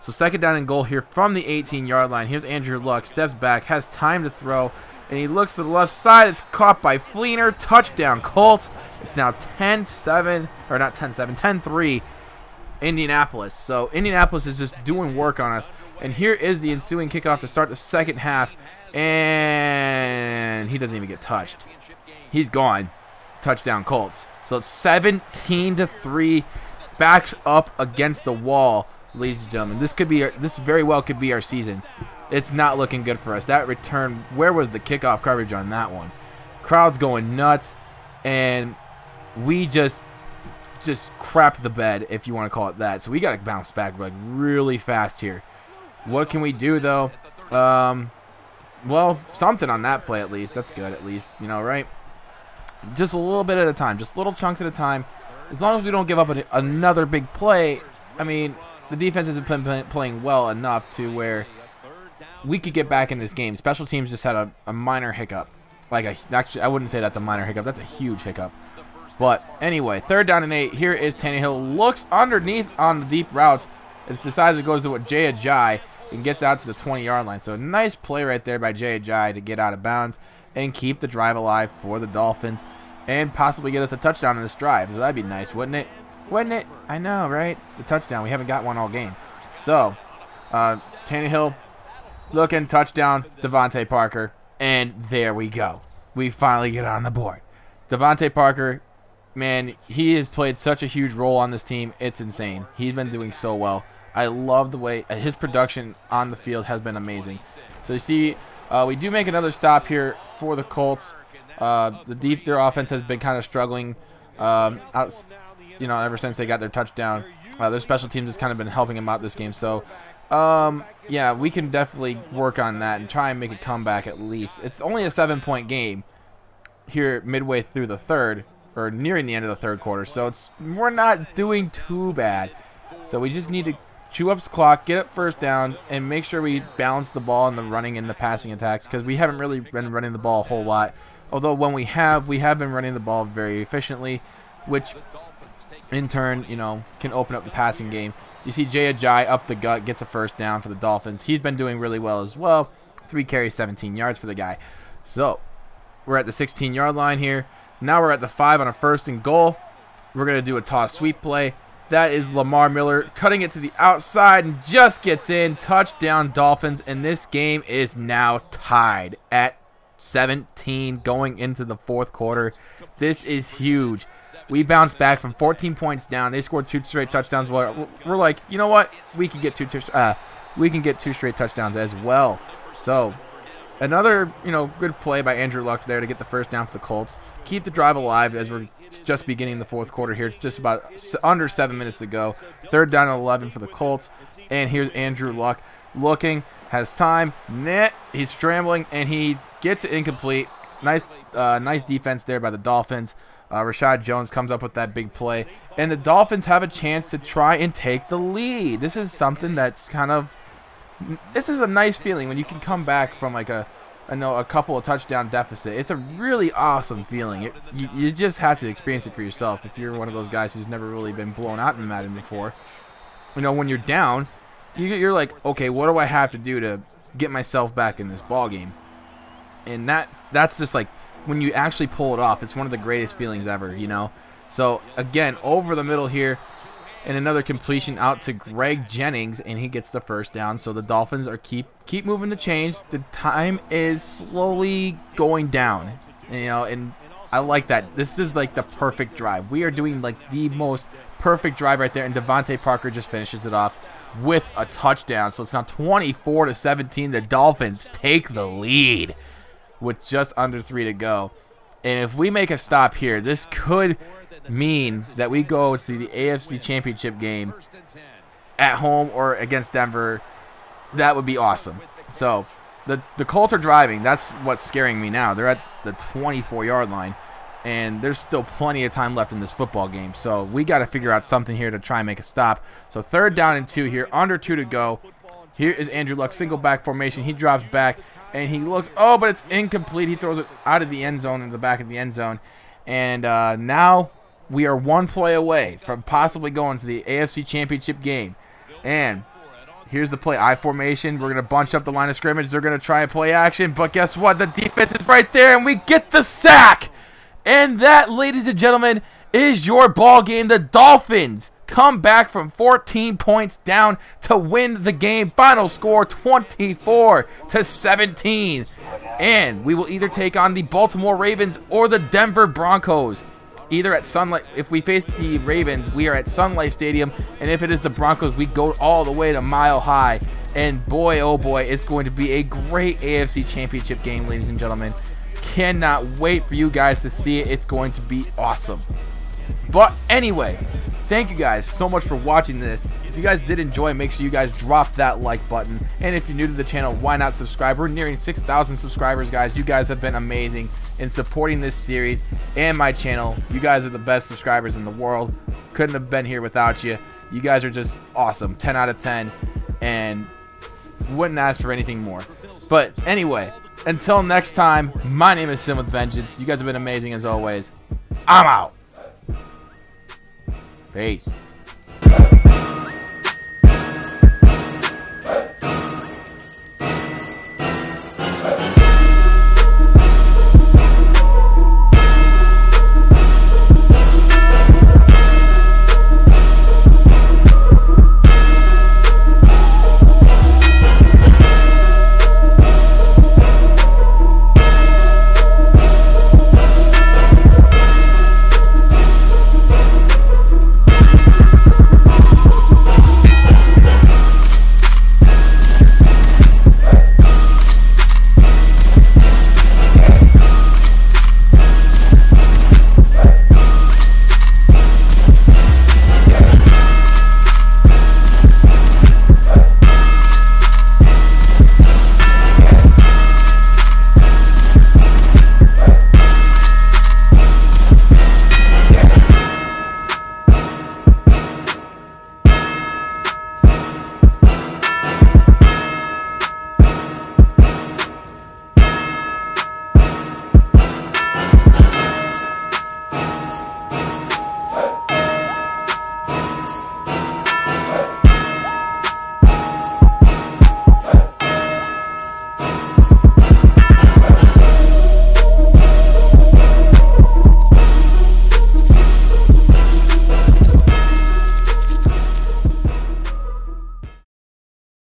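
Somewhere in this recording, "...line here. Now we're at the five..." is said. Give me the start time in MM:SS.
02:36.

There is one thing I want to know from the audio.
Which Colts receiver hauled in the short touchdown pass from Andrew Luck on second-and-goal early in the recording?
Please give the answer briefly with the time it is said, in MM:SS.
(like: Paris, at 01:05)
Fleener, at 00:06.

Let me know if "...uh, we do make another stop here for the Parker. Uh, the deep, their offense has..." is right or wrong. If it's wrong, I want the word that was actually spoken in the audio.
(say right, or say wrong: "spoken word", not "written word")
wrong: "Colts", not "Parker".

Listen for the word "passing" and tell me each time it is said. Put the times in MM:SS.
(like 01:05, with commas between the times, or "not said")
02:18, 02:27.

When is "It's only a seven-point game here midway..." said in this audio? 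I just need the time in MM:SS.
02:04.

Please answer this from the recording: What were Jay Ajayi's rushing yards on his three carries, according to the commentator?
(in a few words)
17.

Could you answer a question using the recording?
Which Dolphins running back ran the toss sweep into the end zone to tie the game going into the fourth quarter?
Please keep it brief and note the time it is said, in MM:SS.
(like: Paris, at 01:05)
Lamar Miller, at 02:42.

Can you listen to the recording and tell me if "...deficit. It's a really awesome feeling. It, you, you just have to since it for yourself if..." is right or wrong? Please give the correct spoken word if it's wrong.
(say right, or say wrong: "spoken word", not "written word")
wrong: "experience", not "since".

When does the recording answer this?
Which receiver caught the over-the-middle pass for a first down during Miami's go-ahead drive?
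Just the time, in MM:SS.
03:58.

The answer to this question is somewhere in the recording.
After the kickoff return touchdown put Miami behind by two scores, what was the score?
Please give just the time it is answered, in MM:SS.
00:24.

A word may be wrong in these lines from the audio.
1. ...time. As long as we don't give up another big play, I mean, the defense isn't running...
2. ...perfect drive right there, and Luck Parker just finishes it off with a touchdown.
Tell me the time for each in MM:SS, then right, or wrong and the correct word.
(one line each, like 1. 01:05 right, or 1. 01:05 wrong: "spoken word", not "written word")
1. 00:54 wrong: "playing", not "running"
2. 04:11 wrong: "DeVante", not "Luck".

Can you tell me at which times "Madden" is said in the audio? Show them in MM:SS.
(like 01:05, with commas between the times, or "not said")
03:41.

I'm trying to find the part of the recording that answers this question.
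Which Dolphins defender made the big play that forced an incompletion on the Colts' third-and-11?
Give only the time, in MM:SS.
03:23.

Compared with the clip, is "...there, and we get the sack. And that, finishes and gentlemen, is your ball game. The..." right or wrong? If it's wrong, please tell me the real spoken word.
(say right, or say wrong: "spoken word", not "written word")
wrong: "ladies", not "finishes".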